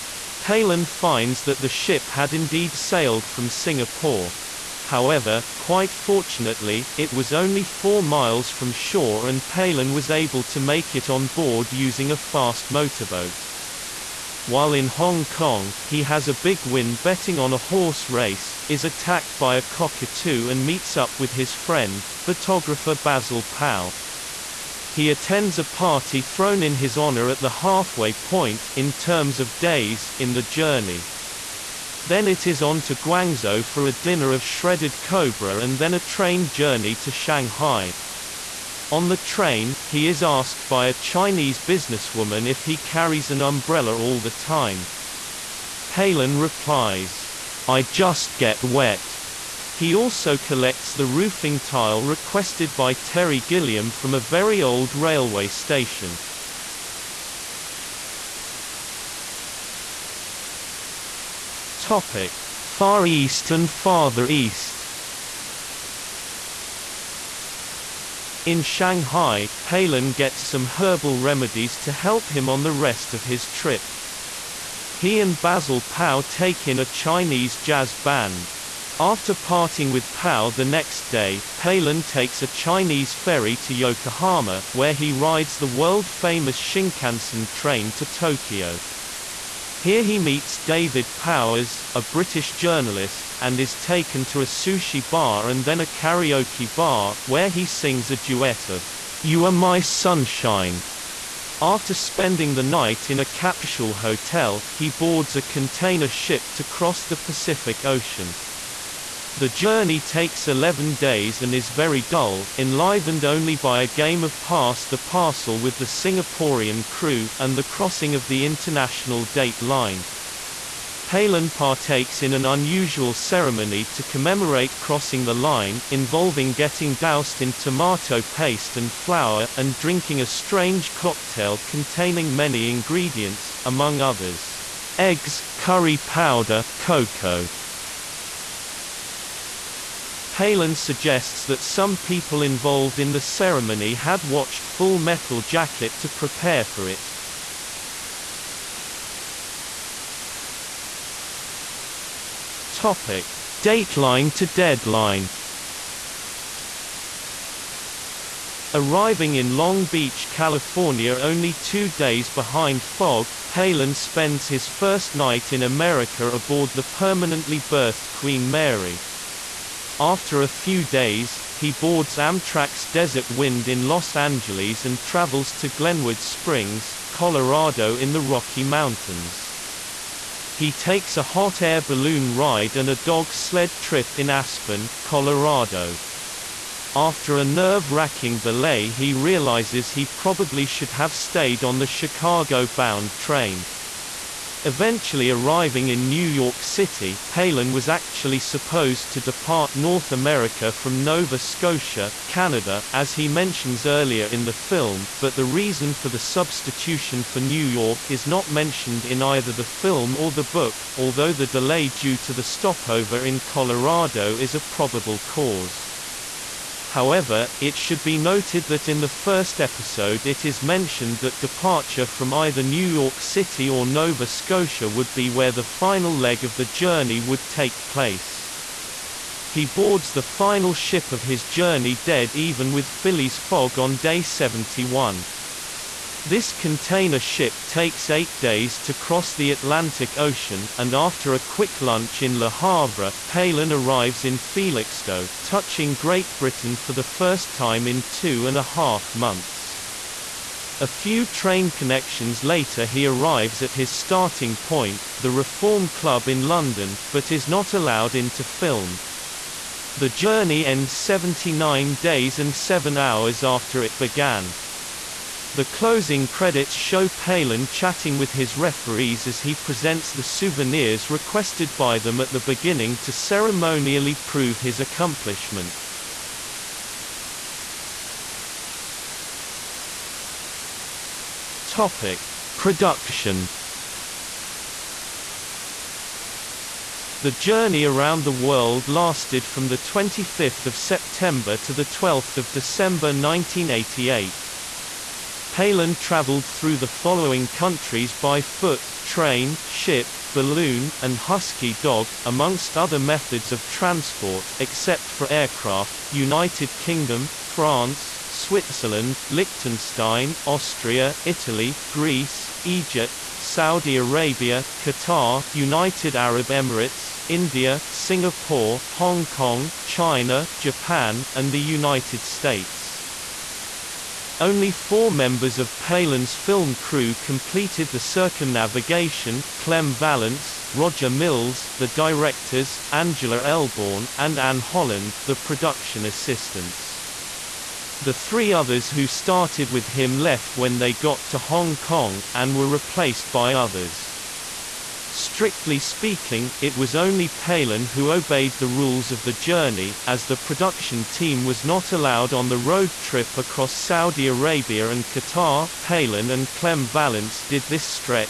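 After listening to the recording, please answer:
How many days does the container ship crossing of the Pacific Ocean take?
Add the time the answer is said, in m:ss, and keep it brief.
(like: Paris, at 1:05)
11, at 1:50.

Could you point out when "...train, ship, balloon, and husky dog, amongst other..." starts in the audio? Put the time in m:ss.
4:59.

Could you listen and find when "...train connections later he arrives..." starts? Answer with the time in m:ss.
4:11.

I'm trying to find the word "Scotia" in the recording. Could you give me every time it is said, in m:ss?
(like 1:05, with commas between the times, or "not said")
3:21, 3:44.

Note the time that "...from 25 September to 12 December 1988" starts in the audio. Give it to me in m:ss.
4:49.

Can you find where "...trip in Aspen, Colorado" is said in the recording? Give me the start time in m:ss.
3:03.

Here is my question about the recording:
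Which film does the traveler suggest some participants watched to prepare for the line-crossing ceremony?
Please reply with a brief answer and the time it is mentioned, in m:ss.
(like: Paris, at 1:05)
Full Metal Jacket, at 2:24.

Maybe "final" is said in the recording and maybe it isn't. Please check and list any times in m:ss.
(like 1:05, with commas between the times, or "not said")
3:45, 3:50.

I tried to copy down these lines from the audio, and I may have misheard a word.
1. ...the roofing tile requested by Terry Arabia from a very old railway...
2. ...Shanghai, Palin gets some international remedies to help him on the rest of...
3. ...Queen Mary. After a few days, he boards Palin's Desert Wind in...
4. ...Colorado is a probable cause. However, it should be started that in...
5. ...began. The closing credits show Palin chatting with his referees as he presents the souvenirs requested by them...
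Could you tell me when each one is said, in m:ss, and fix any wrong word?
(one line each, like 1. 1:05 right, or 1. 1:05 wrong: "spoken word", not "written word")
1. 0:50 wrong: "Gilliam", not "Arabia"
2. 1:08 wrong: "herbal", not "international"
3. 2:48 wrong: "Amtrak", not "Palin"
4. 3:33 wrong: "noted", not "started"
5. 4:23 right.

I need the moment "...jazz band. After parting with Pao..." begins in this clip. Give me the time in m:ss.
1:17.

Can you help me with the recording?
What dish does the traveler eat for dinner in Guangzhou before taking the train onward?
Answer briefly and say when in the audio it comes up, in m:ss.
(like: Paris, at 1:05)
Shredded cobra, at 0:34.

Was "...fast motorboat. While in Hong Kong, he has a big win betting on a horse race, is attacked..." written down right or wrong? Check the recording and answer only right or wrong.
right.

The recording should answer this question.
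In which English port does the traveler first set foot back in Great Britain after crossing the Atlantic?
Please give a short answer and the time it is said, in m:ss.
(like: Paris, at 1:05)
Felixstowe, at 4:04.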